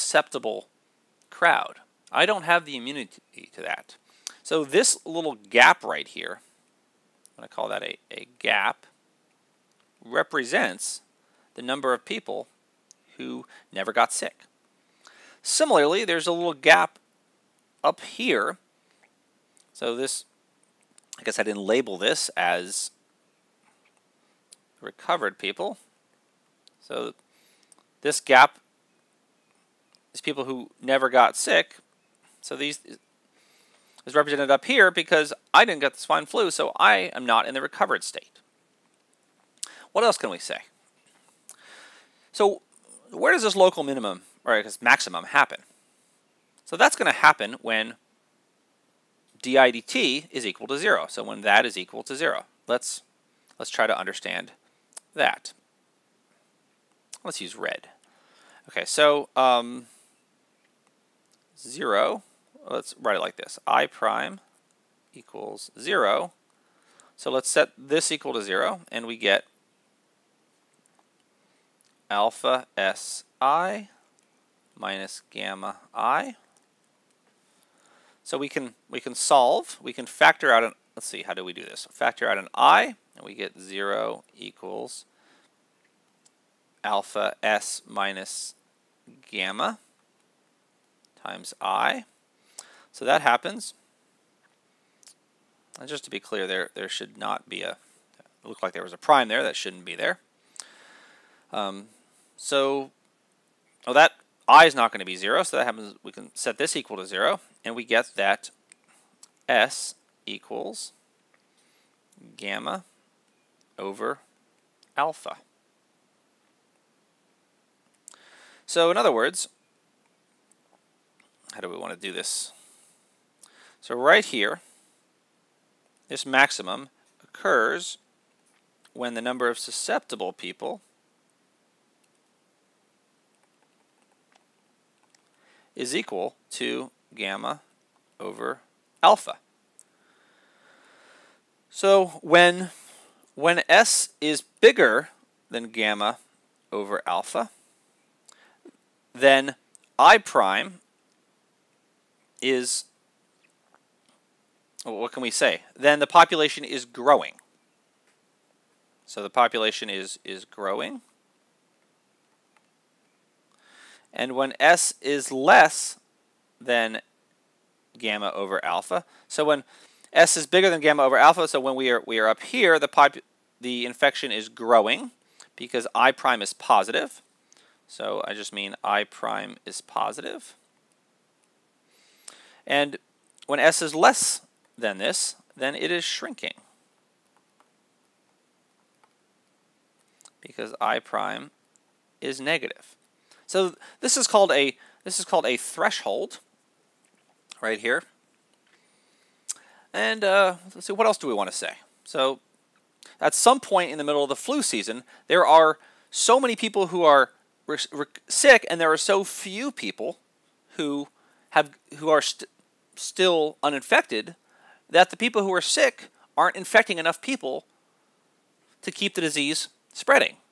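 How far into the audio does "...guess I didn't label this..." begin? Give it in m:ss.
0:21.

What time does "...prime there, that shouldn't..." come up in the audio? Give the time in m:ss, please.
1:38.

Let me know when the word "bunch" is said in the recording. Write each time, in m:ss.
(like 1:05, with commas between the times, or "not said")
not said.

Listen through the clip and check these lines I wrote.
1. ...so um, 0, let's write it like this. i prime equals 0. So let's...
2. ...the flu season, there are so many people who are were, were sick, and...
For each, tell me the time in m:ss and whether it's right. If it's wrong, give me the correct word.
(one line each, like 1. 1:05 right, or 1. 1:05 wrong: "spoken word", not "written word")
1. 0:58 right
2. 3:24 right.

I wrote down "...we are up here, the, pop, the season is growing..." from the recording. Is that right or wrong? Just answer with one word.
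wrong.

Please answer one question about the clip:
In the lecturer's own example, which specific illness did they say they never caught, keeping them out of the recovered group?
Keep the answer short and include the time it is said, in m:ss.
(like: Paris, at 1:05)
swine flu, at 0:36.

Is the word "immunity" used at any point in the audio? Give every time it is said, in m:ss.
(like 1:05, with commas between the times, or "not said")
0:02.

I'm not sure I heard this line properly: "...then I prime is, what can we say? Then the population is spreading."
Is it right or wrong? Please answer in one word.
wrong.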